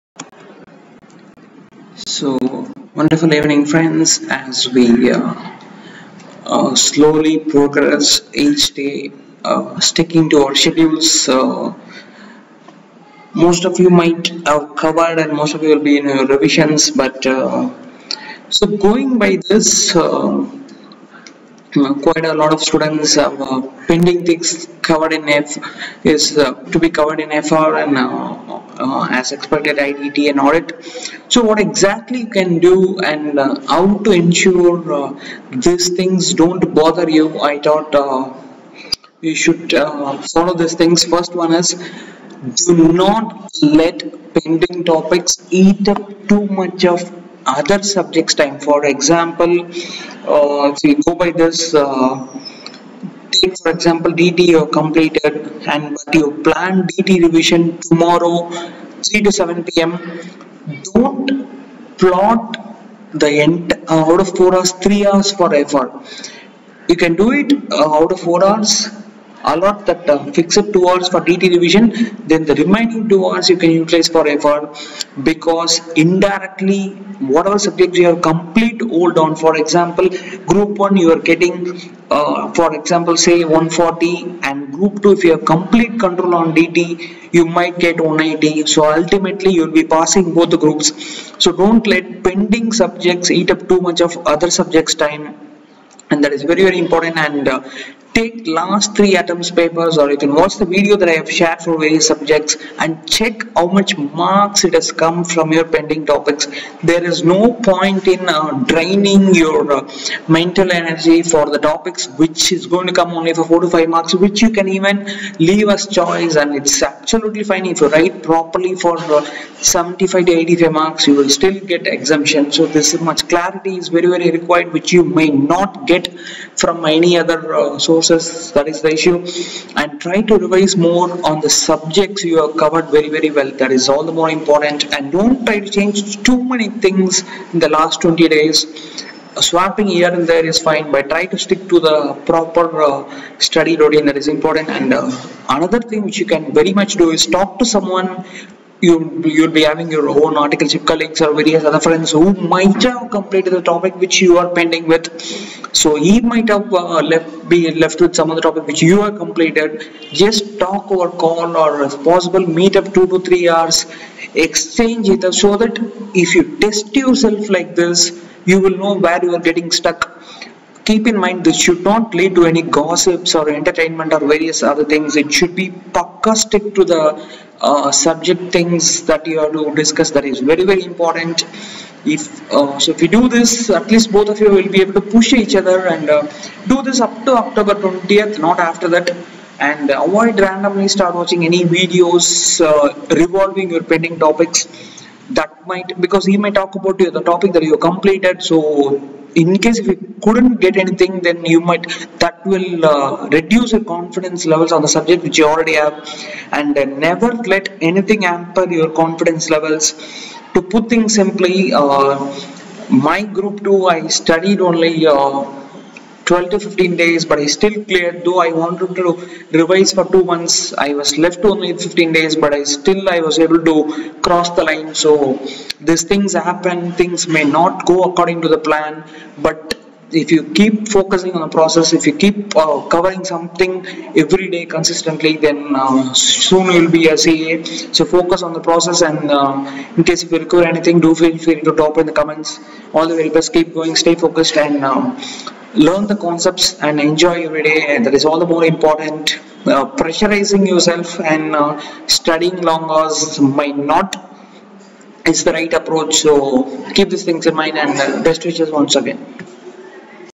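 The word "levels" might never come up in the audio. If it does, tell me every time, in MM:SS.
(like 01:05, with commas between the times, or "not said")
03:24, 03:29.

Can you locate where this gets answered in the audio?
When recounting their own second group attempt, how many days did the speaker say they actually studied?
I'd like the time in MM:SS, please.
03:36.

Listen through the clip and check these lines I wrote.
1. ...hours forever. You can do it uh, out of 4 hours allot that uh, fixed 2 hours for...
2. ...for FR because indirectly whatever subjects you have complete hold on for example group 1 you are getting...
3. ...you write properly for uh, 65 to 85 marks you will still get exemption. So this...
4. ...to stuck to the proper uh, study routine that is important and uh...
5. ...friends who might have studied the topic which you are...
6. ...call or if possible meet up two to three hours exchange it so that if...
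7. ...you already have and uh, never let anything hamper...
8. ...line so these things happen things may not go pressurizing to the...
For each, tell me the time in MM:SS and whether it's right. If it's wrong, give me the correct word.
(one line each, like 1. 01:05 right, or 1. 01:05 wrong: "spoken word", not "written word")
1. 01:05 right
2. 01:14 right
3. 01:57 wrong: "75", not "65"
4. 02:21 wrong: "stick", not "stuck"
5. 02:31 wrong: "completed", not "studied"
6. 02:41 right
7. 03:25 right
8. 03:44 wrong: "according", not "pressurizing".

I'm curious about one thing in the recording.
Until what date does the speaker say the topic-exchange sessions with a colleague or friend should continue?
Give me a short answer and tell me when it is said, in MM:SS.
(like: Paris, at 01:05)
October 20th, at 03:07.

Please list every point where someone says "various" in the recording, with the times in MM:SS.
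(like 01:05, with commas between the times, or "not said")
01:41, 02:31, 02:54.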